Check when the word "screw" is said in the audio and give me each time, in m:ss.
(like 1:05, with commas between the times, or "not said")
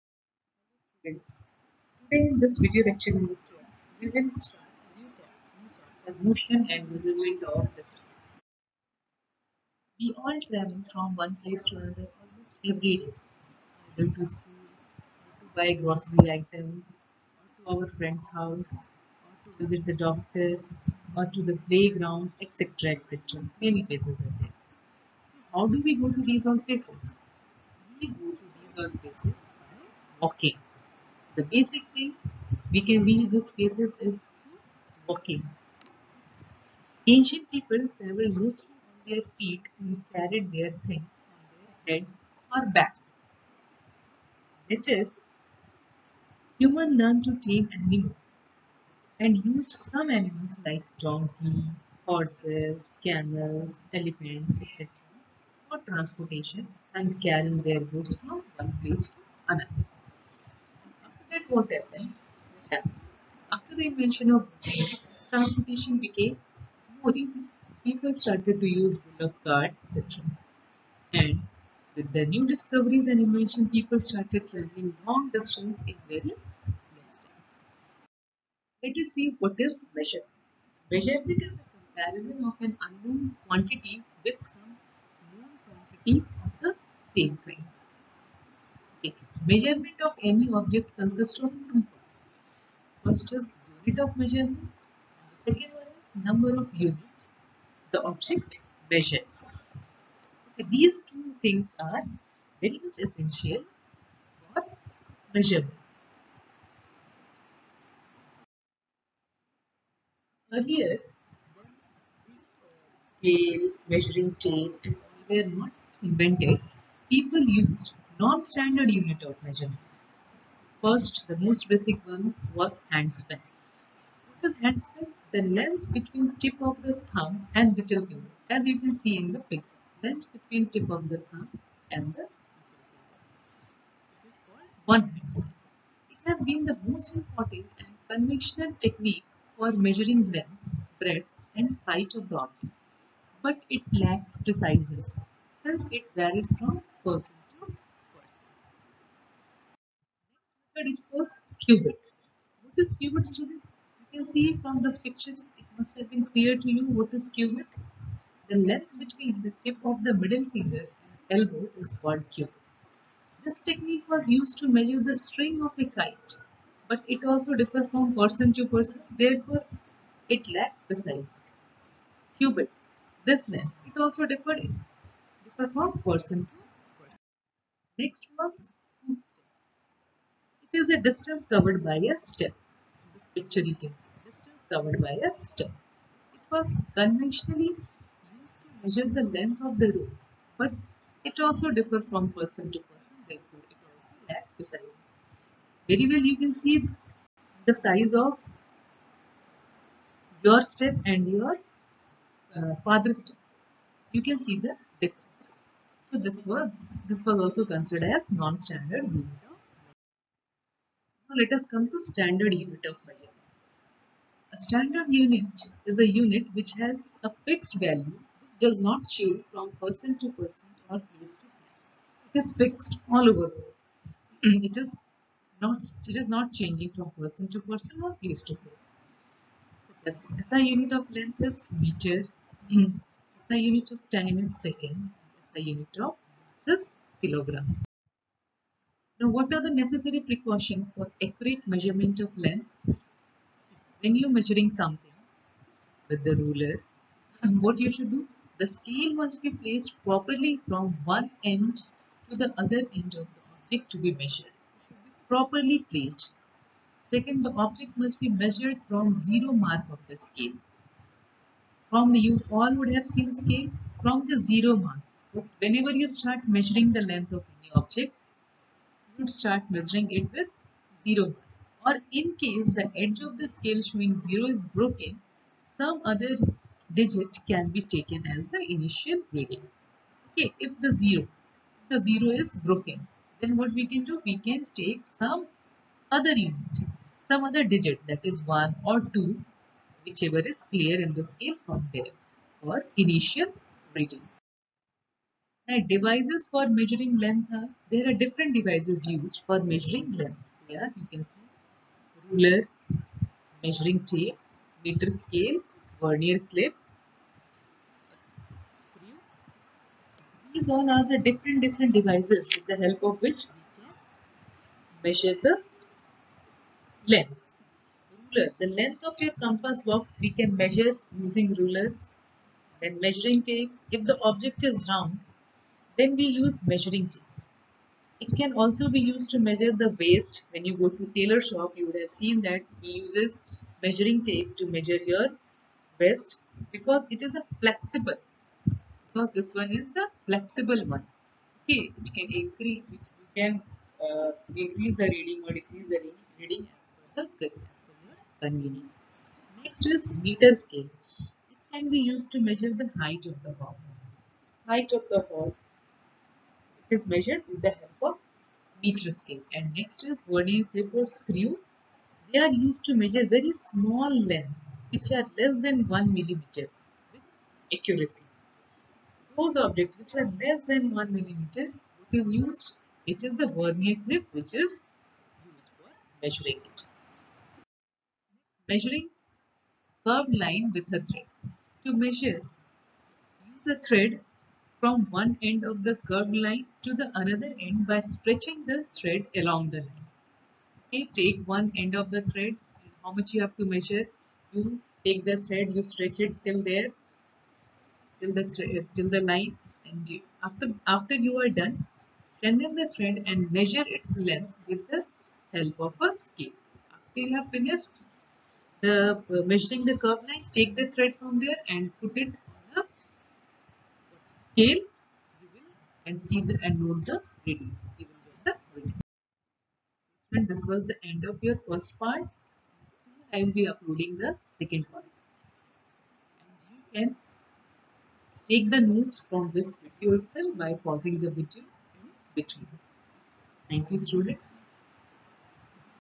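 5:08, 6:01.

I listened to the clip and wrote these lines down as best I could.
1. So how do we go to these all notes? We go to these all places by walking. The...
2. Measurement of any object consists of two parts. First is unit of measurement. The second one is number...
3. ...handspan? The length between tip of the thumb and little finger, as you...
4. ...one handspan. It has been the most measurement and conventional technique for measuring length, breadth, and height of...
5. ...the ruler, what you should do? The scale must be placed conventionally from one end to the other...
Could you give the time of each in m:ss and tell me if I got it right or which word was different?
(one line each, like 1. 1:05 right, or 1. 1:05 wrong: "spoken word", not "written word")
1. 0:25 wrong: "places", not "notes"
2. 1:29 right
3. 2:04 right
4. 2:14 wrong: "important", not "measurement"
5. 4:06 wrong: "properly", not "conventionally".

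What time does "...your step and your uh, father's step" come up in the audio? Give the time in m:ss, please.
3:20.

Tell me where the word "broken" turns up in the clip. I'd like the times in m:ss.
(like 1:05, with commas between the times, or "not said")
4:34, 4:42.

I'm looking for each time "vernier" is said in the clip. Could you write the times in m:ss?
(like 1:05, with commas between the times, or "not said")
5:05, 6:00, 6:13.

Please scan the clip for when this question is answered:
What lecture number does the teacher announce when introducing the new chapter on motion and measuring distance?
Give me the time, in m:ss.
0:03.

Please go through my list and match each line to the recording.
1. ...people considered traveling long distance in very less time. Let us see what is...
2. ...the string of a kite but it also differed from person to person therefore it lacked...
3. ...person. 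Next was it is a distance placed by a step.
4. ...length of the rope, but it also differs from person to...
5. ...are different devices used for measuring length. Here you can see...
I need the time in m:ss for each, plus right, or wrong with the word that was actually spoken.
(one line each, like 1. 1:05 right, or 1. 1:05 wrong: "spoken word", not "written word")
1. 1:13 wrong: "started", not "considered"
2. 2:45 right
3. 2:57 wrong: "covered", not "placed"
4. 3:09 right
5. 4:58 right.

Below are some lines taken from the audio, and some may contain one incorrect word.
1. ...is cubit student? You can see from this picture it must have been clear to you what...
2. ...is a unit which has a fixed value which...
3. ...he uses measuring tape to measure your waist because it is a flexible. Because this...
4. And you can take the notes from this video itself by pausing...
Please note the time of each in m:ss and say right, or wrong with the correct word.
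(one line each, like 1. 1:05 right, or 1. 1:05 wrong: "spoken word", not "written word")
1. 2:32 right
2. 3:35 right
3. 5:32 right
4. 7:06 right.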